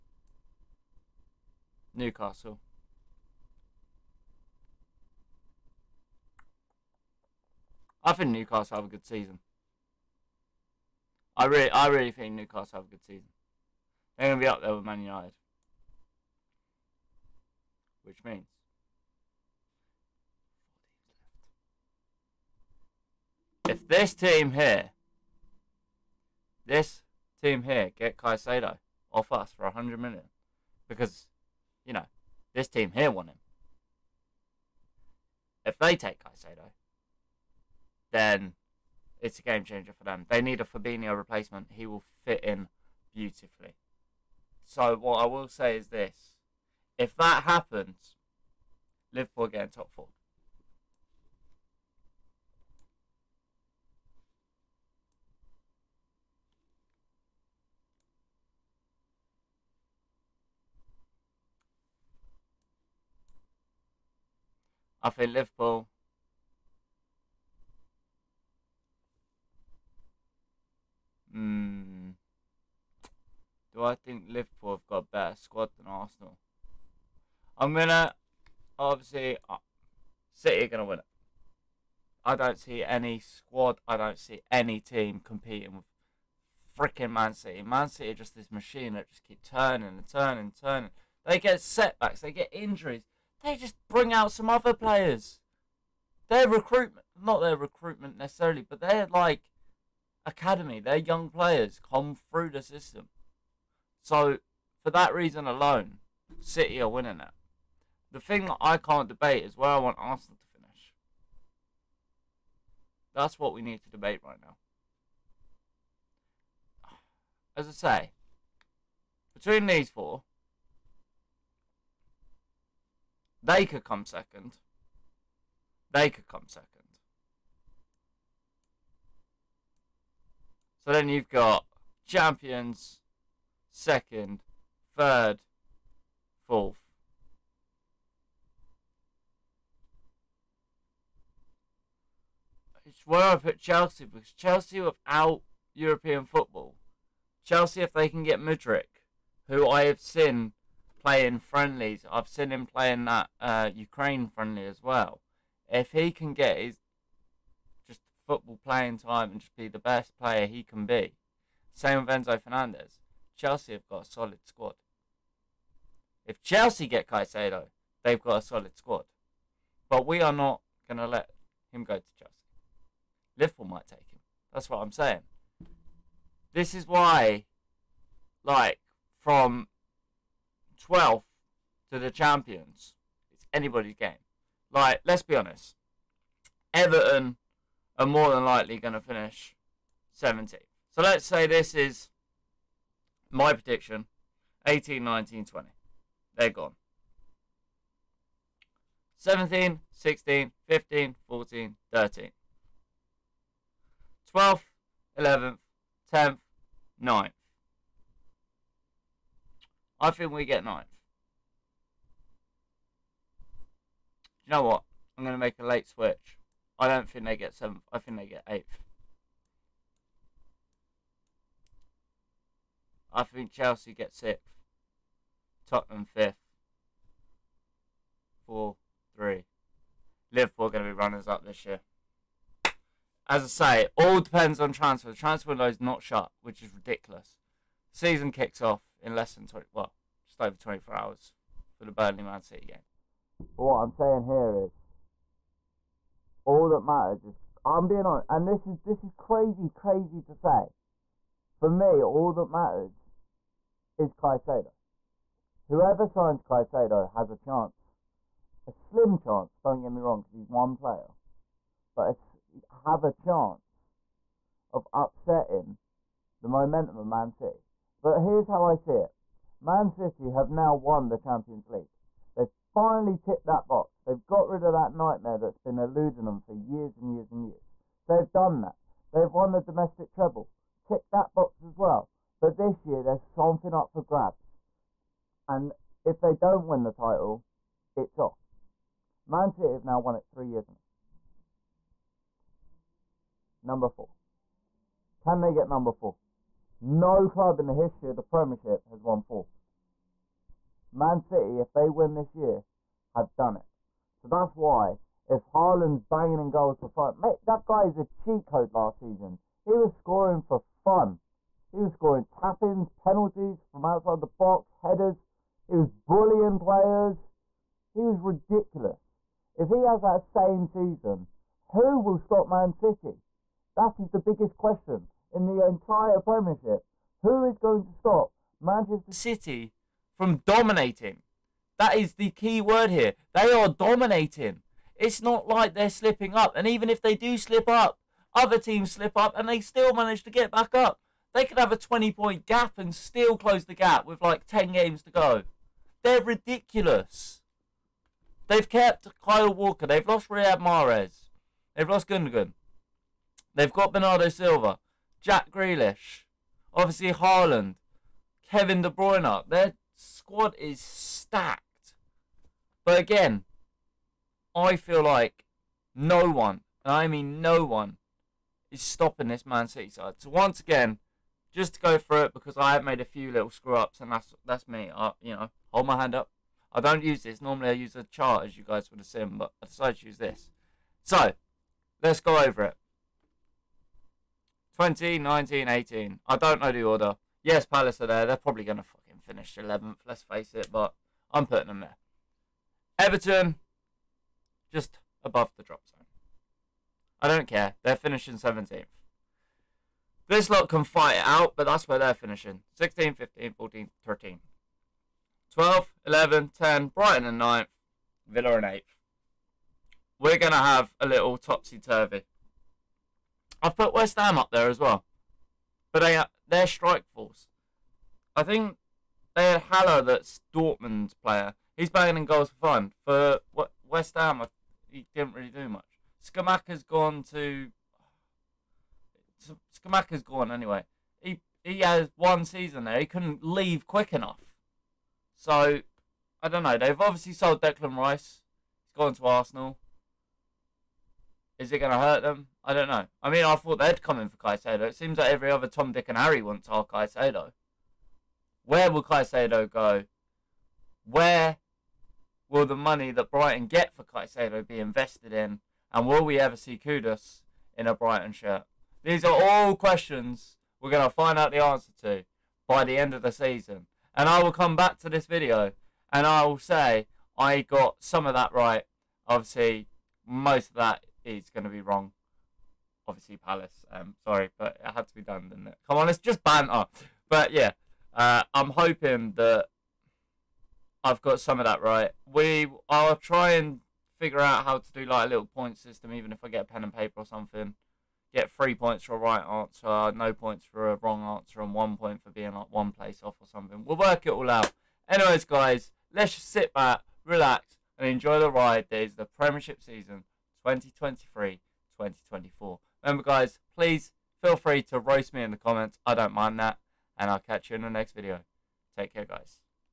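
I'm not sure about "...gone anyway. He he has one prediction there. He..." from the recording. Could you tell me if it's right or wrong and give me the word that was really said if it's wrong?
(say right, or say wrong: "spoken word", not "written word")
wrong: "season", not "prediction".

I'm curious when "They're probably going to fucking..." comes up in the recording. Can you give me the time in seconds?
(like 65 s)
388 s.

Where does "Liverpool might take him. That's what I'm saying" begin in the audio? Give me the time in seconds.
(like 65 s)
173 s.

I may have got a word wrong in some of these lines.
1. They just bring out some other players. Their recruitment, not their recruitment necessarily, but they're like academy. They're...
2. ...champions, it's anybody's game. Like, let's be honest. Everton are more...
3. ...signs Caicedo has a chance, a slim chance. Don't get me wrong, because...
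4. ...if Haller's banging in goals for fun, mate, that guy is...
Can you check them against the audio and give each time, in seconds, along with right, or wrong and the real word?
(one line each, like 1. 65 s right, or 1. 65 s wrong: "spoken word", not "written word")
1. 93 s right
2. 182 s right
3. 256 s right
4. 305 s wrong: "Haaland", not "Haller".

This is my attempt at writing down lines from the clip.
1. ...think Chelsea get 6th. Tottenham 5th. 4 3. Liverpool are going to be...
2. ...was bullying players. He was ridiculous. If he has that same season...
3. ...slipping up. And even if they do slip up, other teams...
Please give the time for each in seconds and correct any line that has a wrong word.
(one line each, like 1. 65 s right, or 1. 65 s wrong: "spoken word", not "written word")
1. 223 s right
2. 315 s right
3. 335 s right.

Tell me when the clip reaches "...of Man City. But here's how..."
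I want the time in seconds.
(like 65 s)
266 s.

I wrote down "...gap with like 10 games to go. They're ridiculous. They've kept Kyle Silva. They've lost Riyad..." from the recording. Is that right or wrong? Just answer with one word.
wrong.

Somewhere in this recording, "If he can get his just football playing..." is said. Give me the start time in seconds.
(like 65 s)
155 s.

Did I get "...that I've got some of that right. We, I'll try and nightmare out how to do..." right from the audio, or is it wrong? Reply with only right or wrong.
wrong.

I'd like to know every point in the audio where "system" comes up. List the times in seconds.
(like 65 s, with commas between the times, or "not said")
102 s, 485 s.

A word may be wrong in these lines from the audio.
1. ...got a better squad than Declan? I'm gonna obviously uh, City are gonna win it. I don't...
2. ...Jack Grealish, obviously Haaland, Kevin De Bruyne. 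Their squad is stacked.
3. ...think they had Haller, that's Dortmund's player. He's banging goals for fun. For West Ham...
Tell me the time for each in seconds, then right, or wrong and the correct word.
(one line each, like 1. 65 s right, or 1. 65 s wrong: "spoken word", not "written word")
1. 74 s wrong: "Arsenal", not "Declan"
2. 355 s right
3. 418 s right.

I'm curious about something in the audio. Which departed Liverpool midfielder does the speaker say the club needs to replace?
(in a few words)
Fabinho.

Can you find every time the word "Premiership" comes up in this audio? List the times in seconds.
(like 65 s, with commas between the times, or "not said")
298 s, 326 s, 499 s.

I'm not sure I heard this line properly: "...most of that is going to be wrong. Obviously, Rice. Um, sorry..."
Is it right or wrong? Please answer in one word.
wrong.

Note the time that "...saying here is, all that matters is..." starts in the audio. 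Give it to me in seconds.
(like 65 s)
243 s.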